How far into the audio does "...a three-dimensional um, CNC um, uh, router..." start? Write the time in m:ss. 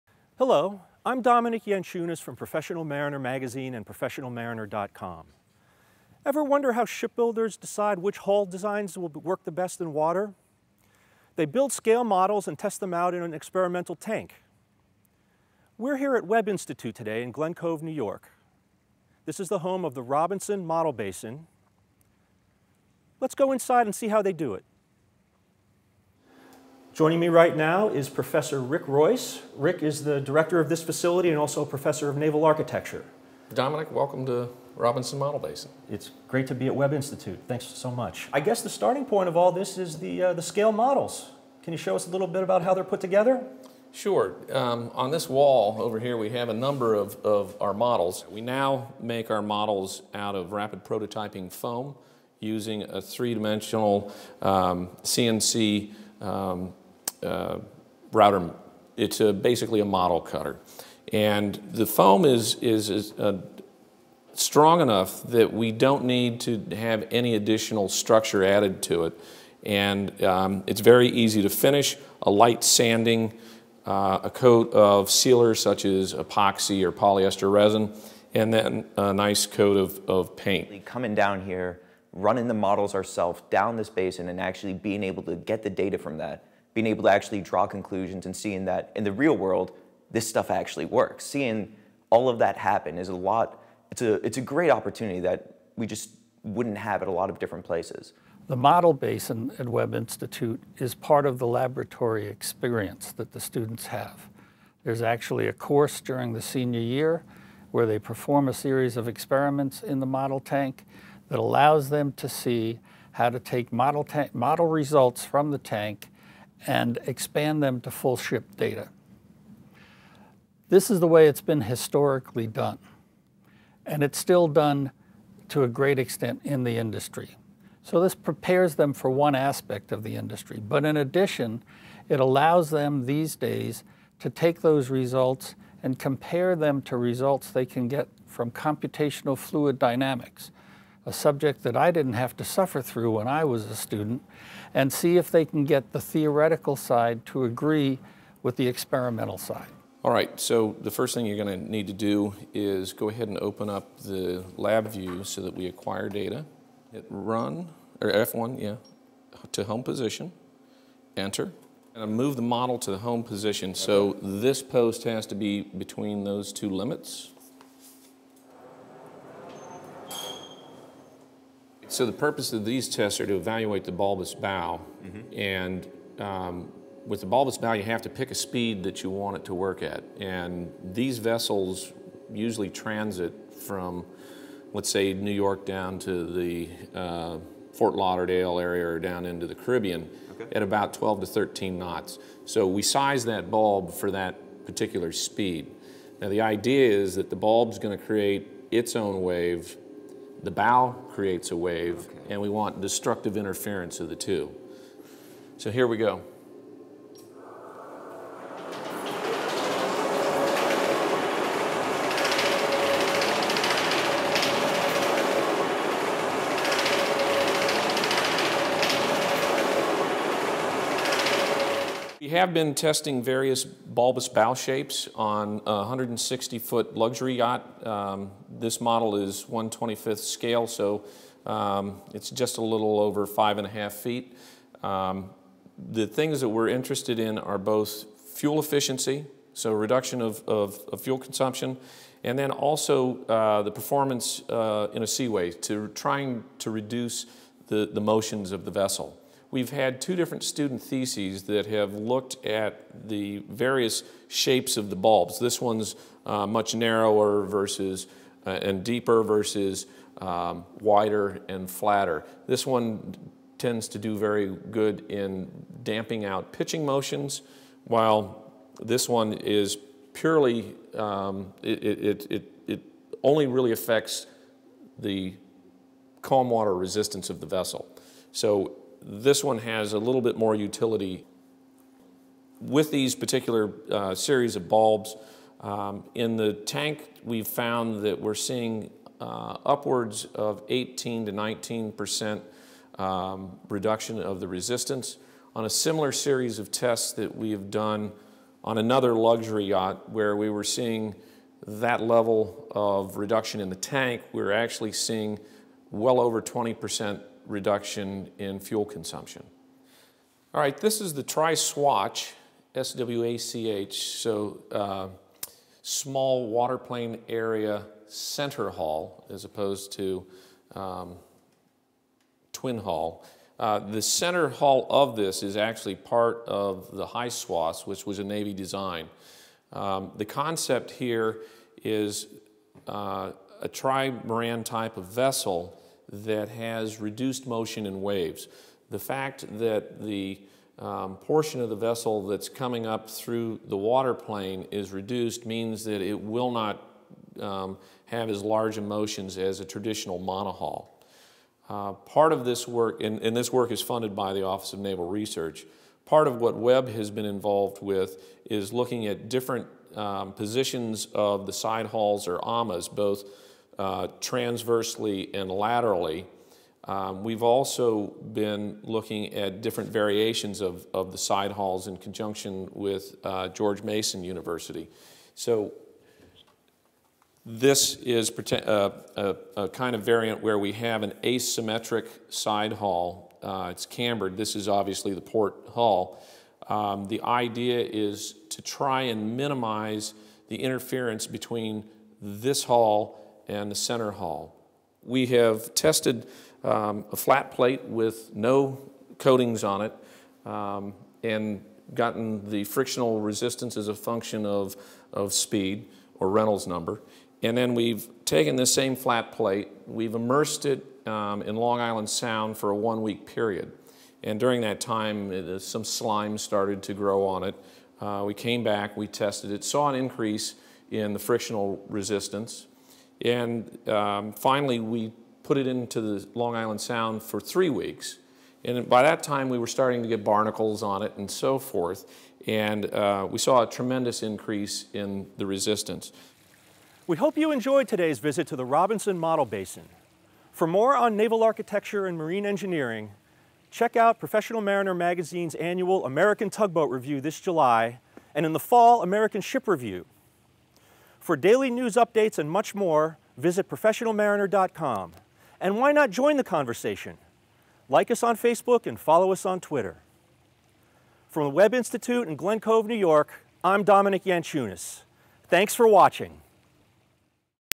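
0:52.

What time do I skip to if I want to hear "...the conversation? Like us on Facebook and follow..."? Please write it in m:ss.
7:36.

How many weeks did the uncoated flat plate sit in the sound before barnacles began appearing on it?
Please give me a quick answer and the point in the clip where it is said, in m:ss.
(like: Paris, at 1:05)
3, at 7:07.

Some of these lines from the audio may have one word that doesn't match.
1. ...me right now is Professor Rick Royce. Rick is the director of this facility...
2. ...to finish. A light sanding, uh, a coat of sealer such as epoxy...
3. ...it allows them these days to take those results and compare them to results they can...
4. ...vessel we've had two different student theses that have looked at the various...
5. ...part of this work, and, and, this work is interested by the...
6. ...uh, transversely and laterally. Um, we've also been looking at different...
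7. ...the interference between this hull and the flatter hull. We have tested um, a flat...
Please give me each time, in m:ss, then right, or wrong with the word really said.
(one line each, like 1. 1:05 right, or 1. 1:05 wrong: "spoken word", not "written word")
1. 0:27 right
2. 1:11 right
3. 2:12 right
4. 4:08 right
5. 5:51 wrong: "funded", not "interested"
6. 6:03 right
7. 6:30 wrong: "center", not "flatter".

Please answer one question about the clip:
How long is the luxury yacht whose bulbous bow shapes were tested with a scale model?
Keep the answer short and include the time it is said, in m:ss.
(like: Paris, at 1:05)
160 feet, at 3:45.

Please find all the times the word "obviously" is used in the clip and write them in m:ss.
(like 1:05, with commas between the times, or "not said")
6:24.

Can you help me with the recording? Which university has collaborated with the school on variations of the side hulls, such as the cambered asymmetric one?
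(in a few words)
George Mason University.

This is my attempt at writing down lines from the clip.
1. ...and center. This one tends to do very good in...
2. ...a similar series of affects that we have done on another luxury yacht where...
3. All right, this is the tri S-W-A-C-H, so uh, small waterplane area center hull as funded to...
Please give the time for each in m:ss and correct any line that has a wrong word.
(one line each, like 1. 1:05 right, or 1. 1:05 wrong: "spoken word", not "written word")
1. 4:21 wrong: "flatter", not "center"
2. 4:55 wrong: "tests", not "affects"
3. 5:10 wrong: "opposed", not "funded".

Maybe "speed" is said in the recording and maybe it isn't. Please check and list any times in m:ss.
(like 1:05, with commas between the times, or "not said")
2:58, 3:15, 6:45.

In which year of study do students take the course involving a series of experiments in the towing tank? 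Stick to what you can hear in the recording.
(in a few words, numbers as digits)
senior year.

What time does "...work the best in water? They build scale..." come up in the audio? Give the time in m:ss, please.
0:09.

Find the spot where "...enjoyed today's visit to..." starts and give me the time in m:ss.
7:17.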